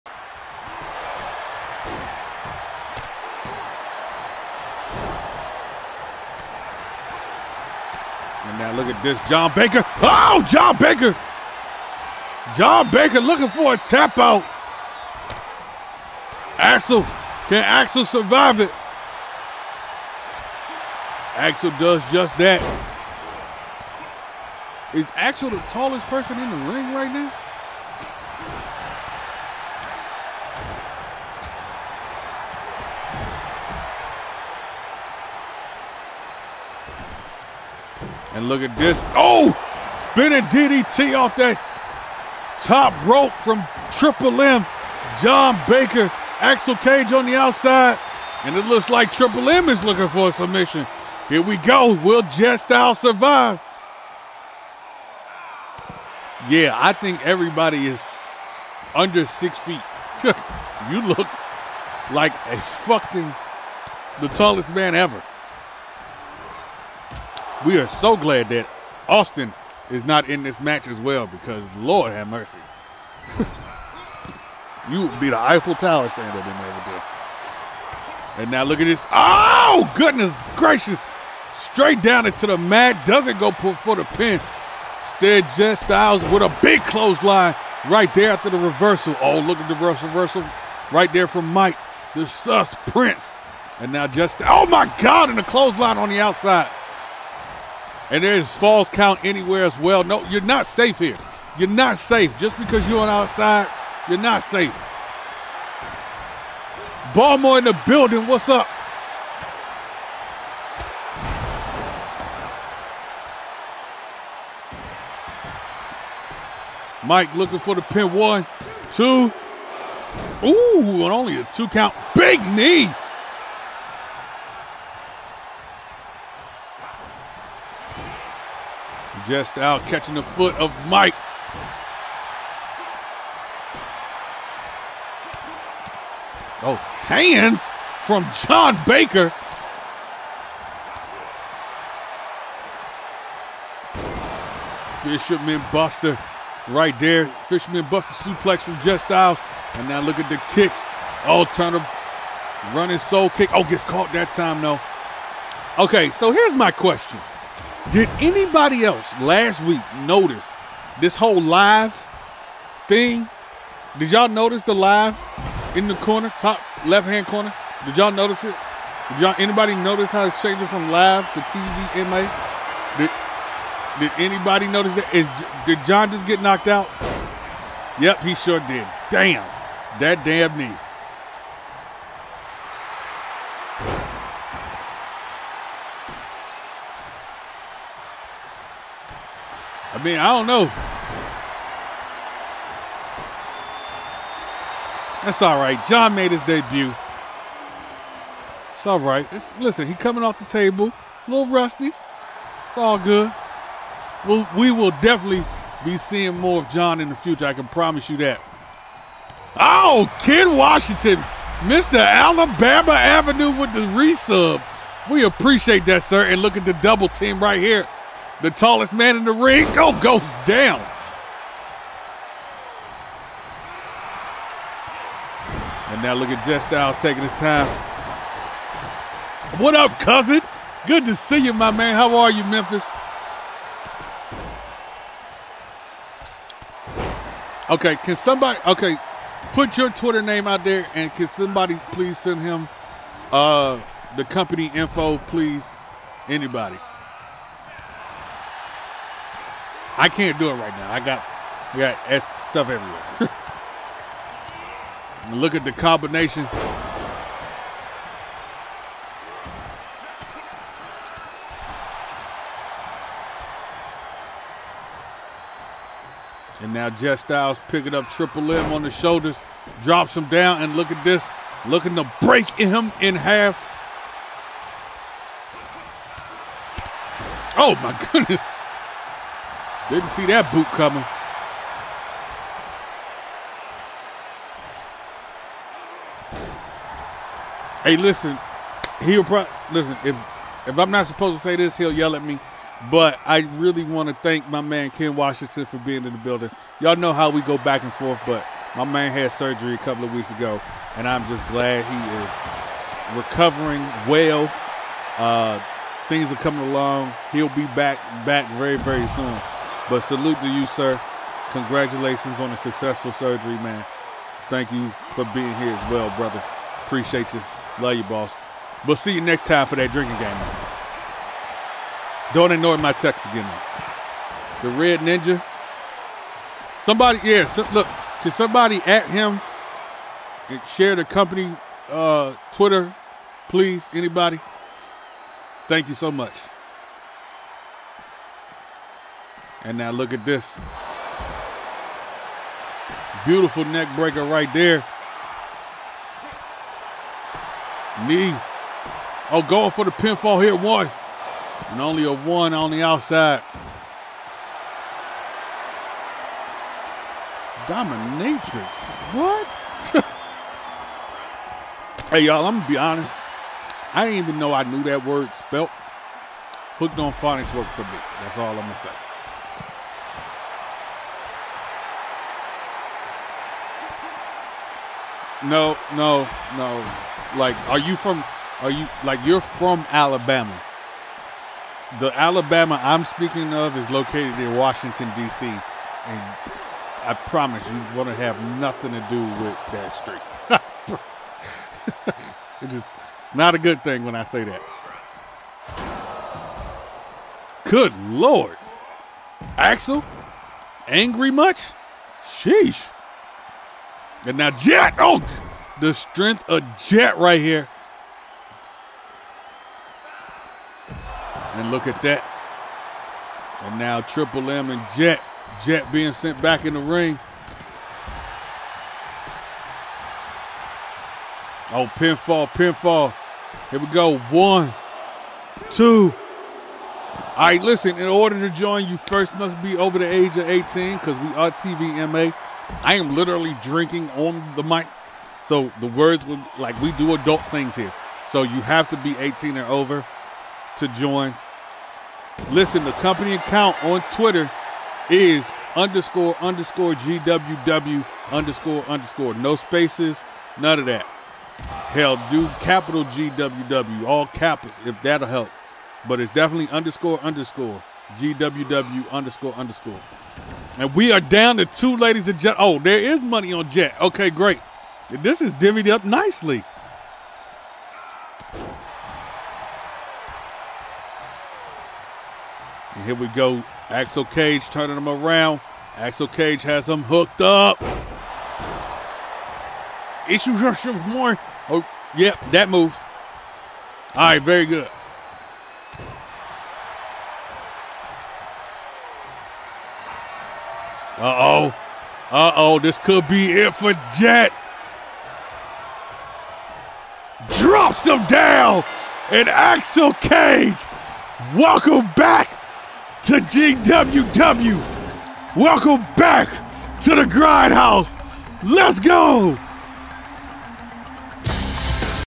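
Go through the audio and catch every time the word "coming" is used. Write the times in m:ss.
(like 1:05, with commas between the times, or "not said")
3:19, 4:40, 5:06.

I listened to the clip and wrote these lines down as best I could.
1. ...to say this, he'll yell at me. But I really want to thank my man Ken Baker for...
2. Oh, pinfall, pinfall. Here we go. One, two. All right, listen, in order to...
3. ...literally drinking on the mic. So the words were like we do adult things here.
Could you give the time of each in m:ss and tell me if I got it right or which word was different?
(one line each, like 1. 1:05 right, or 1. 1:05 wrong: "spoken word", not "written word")
1. 4:51 wrong: "Washington", not "Baker"
2. 7:01 right
3. 7:13 right.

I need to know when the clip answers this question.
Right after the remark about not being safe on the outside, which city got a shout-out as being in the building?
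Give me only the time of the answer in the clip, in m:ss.
1:47.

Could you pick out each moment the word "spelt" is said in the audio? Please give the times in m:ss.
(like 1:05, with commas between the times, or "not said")
6:05.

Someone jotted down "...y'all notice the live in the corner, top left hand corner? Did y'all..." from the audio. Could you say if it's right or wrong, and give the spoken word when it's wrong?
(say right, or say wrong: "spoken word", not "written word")
right.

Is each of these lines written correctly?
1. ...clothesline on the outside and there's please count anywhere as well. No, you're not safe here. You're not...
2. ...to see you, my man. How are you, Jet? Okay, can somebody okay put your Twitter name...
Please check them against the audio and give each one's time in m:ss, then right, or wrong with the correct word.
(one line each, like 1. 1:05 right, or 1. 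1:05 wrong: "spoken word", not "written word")
1. 1:35 wrong: "false", not "please"
2. 3:51 wrong: "Memphis", not "Jet".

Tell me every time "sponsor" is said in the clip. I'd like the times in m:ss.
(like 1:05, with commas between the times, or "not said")
not said.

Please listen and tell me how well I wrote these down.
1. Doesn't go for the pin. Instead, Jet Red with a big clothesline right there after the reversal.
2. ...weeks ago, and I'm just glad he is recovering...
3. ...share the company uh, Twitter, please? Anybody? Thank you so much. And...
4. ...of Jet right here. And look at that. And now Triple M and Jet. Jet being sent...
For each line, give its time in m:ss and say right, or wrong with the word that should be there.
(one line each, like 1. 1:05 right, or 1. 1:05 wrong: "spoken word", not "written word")
1. 1:23 wrong: "Styles", not "Red"
2. 5:00 right
3. 5:30 right
4. 6:46 right.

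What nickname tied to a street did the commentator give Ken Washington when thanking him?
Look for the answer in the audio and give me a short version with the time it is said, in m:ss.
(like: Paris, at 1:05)
Mr. Alabama Avenue, at 3:31.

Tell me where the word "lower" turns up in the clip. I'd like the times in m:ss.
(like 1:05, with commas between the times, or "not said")
not said.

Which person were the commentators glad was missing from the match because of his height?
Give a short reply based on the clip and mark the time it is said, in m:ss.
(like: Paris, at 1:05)
Austin, at 1:09.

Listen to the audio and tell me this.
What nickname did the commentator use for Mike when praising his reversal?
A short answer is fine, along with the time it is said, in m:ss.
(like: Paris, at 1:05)
the sus prince, at 1:32.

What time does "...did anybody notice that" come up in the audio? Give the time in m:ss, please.
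2:53.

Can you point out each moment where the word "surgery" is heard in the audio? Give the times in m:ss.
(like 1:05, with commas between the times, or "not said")
4:59, 5:13.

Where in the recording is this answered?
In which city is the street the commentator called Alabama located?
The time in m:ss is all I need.
6:24.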